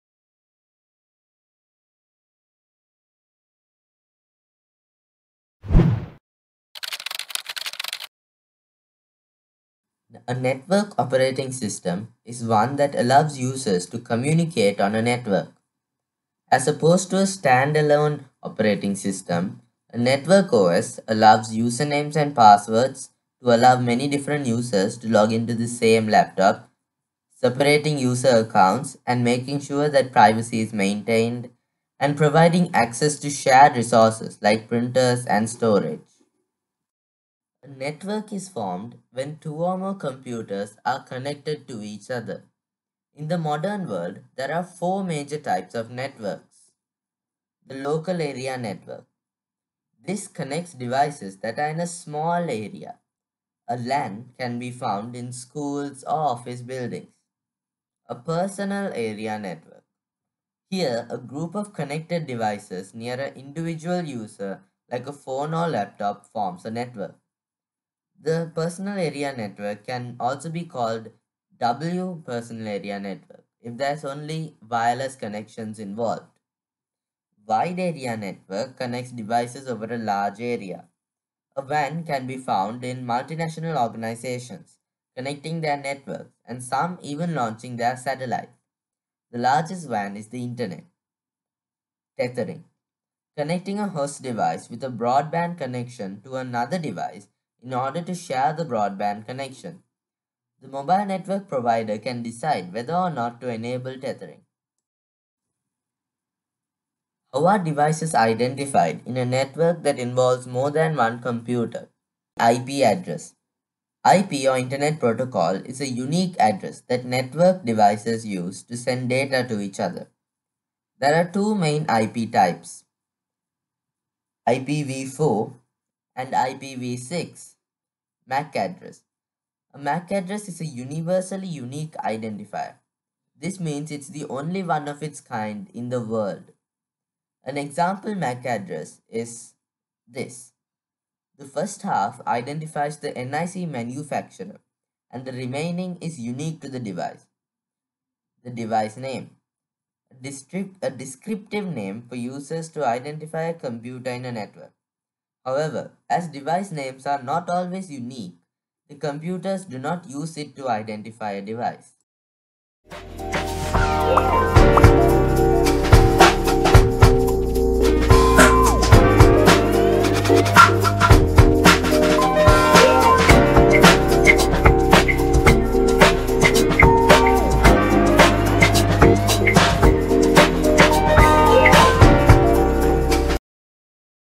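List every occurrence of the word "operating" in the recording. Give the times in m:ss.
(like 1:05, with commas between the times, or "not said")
0:10, 0:18.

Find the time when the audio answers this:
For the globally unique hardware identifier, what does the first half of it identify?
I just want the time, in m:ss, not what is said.
2:23.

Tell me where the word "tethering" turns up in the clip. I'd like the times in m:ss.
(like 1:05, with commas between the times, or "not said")
1:32, 1:43.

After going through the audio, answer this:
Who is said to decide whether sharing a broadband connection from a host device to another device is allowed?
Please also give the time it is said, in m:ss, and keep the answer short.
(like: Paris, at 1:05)
mobile network provider, at 1:40.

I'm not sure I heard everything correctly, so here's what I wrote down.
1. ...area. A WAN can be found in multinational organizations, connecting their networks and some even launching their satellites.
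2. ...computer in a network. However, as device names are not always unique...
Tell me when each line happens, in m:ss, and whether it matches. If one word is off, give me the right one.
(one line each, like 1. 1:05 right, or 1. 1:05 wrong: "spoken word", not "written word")
1. 1:20 right
2. 2:33 right.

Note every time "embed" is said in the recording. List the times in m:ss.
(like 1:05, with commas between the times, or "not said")
not said.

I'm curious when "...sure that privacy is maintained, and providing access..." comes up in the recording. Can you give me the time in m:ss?
0:29.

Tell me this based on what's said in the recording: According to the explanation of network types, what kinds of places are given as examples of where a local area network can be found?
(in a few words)
schools or office buildings.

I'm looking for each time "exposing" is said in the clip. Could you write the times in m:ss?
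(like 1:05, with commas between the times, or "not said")
not said.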